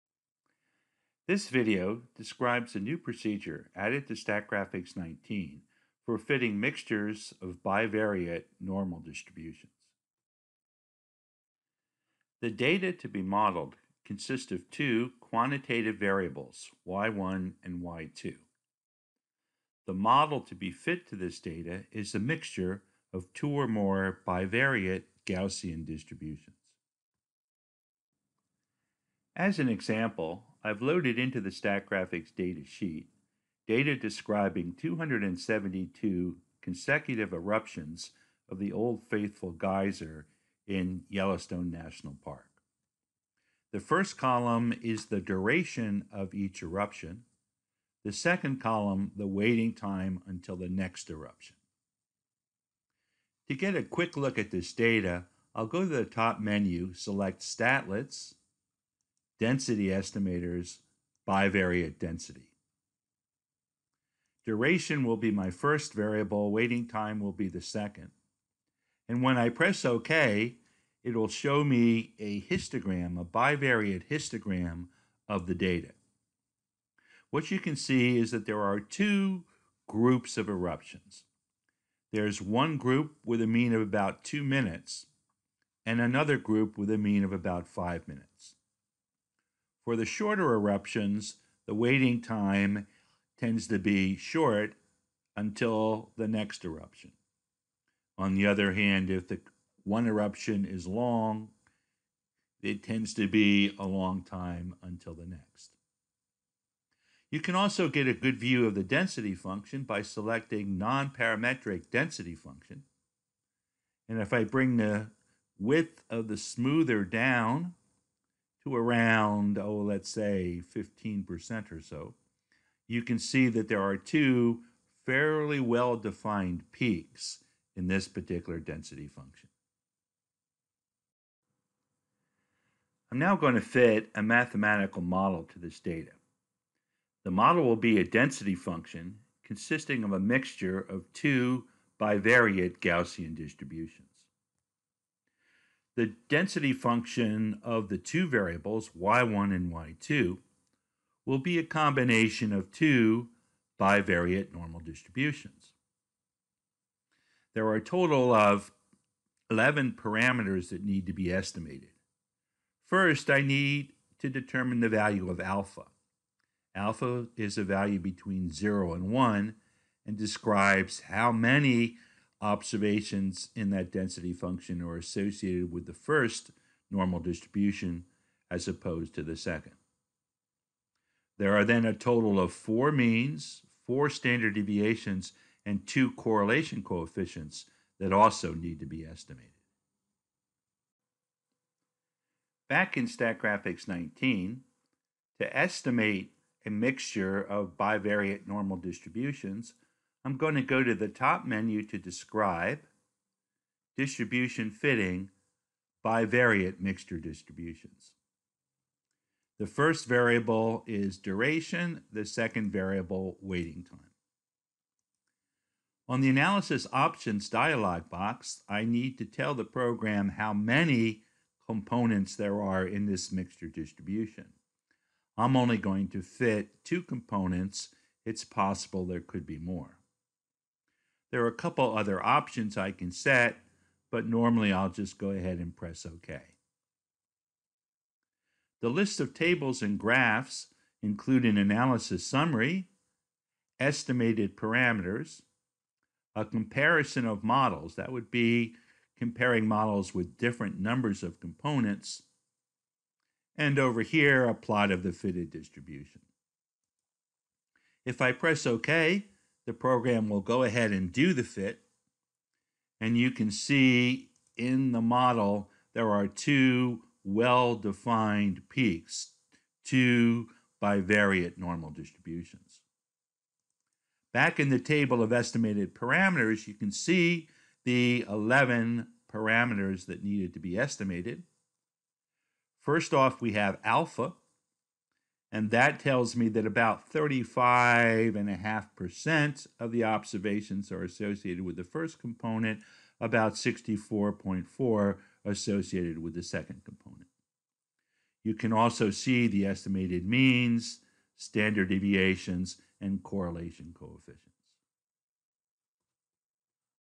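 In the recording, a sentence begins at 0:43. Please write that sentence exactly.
The first column is the duration of each eruption, the second column, the waiting time until the next eruption.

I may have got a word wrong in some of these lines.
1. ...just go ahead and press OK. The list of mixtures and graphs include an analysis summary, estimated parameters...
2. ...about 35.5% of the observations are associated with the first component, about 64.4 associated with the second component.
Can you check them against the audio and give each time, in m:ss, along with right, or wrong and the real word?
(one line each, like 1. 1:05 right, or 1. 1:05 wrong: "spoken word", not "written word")
1. 3:54 wrong: "tables", not "mixtures"
2. 4:46 right.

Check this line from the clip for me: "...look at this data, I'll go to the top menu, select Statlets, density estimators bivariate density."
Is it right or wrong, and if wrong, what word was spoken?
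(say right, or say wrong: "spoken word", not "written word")
right.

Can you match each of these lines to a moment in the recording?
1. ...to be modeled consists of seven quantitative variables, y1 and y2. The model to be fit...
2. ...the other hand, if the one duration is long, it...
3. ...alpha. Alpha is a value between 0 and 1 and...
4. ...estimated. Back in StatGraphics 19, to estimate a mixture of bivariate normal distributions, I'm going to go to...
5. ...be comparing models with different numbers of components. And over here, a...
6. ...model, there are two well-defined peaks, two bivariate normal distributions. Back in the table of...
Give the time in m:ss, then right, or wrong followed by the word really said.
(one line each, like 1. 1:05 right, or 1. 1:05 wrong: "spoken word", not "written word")
1. 0:12 wrong: "two", not "seven"
2. 1:38 wrong: "eruption", not "duration"
3. 2:45 right
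4. 3:09 right
5. 4:08 right
6. 4:25 right.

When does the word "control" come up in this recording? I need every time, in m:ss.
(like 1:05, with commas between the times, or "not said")
not said.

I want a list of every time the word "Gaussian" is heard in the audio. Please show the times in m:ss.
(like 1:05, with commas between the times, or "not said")
0:25, 2:22.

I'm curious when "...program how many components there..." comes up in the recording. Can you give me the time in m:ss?
3:39.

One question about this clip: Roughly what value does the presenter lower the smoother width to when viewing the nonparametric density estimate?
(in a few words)
15%.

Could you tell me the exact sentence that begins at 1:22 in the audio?
There's one group with a mean of about two minutes, and another group with a mean of about five minutes.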